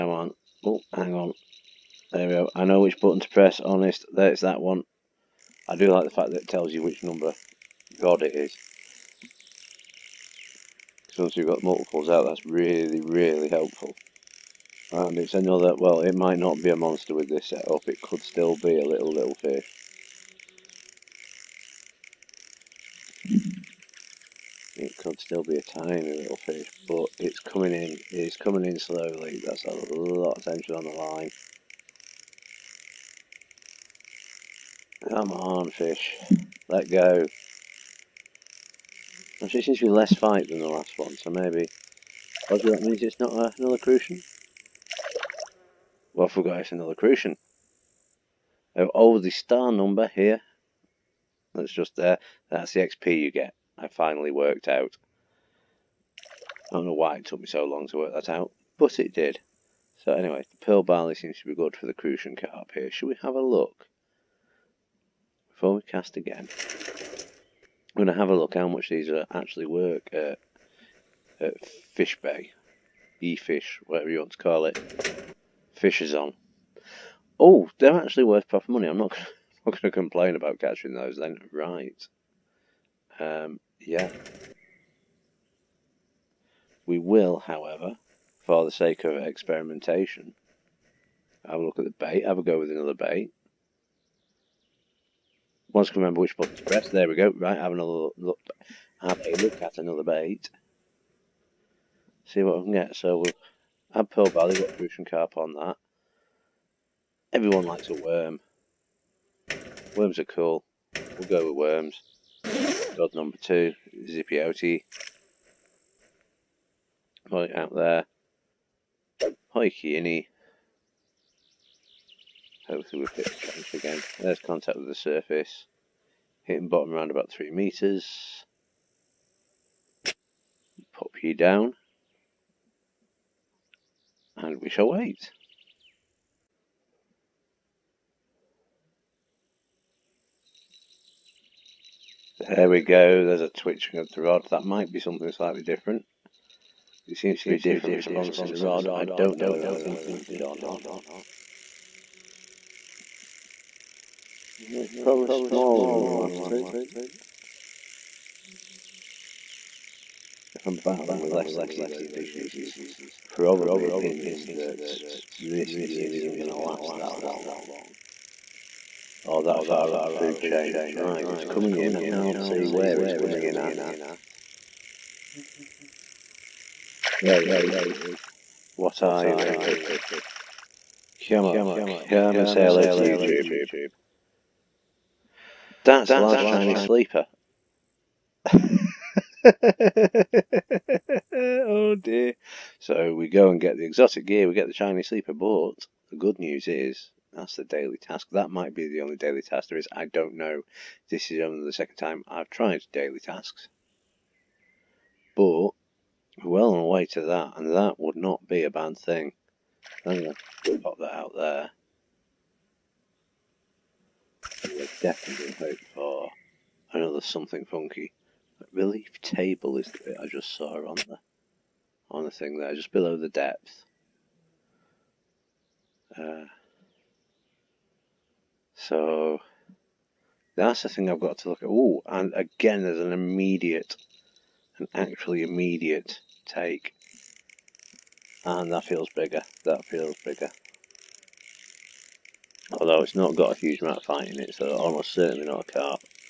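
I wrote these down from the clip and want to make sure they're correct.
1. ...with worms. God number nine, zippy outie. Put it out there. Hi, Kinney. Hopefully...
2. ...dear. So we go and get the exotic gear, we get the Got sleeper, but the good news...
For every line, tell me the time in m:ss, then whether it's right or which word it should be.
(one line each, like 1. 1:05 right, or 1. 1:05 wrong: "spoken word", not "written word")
1. 1:51 wrong: "two", not "nine"
2. 3:11 wrong: "Chinese", not "Got".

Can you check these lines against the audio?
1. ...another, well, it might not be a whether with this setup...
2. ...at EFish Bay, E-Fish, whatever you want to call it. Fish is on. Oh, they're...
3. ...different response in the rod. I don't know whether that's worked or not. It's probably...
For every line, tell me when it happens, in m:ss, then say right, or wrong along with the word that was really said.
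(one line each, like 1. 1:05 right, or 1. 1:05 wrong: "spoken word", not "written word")
1. 0:15 wrong: "monster", not "whether"
2. 1:11 wrong: "Fish", not "EFish"
3. 2:27 wrong: "implemented", not "worked".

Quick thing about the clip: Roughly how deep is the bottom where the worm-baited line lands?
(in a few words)
3 meters.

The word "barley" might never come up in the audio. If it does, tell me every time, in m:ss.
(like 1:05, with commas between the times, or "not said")
1:00, 1:44.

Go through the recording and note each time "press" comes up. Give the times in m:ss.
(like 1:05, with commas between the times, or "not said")
0:03, 1:36.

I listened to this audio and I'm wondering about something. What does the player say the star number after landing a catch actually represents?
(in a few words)
XP.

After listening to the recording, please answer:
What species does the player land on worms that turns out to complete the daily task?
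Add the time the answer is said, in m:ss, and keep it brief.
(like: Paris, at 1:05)
large Chinese sleeper, at 3:06.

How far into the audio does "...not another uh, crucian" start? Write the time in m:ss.
0:43.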